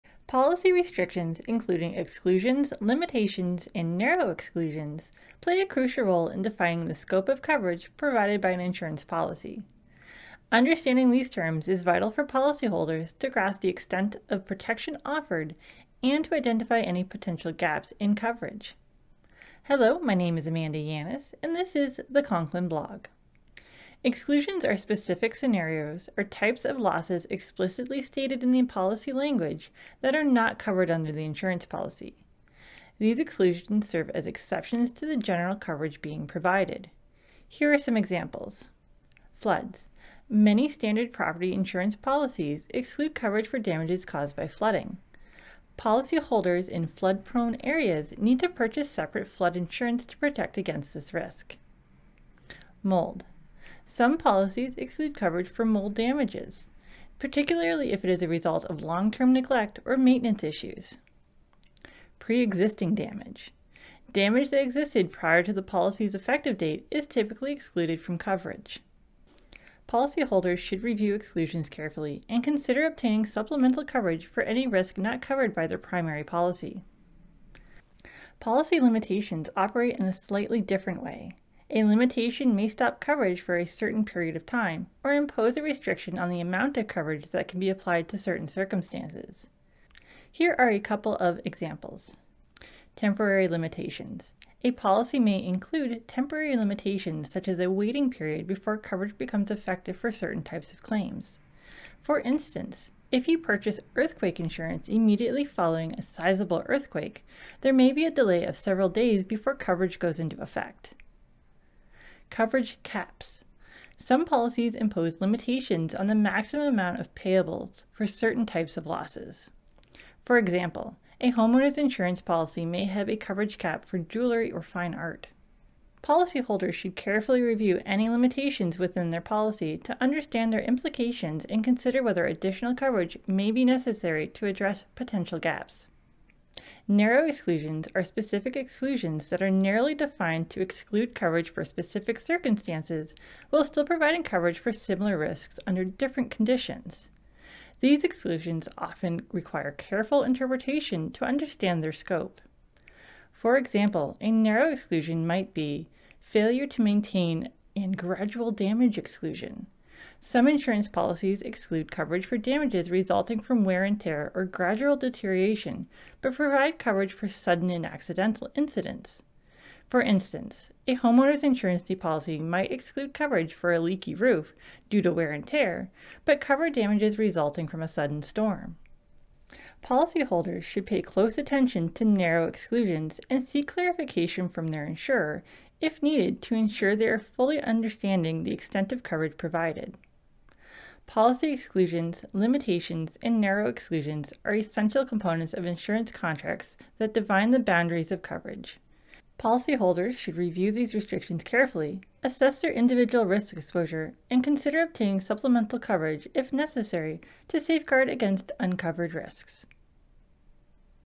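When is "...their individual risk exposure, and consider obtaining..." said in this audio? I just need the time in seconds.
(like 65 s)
202 s.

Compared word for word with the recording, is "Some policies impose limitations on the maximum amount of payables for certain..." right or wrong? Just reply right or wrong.
right.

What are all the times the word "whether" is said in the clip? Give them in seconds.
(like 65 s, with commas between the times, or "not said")
132 s.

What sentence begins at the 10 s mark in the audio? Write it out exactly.
Understanding these terms is vital for policyholders to grasp the extent of protection offered and to identify any potential gaps in coverage.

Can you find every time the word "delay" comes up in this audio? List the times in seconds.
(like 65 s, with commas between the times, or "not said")
108 s.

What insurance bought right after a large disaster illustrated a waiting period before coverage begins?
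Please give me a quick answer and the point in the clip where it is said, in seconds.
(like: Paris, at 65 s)
Earthquake insurance, at 103 s.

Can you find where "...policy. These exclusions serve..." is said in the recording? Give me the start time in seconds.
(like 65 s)
31 s.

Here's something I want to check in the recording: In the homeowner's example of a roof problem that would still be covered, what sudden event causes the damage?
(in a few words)
A sudden storm.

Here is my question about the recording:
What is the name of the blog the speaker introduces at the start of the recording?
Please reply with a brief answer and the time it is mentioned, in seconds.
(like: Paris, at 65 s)
Concklin blog, at 22 s.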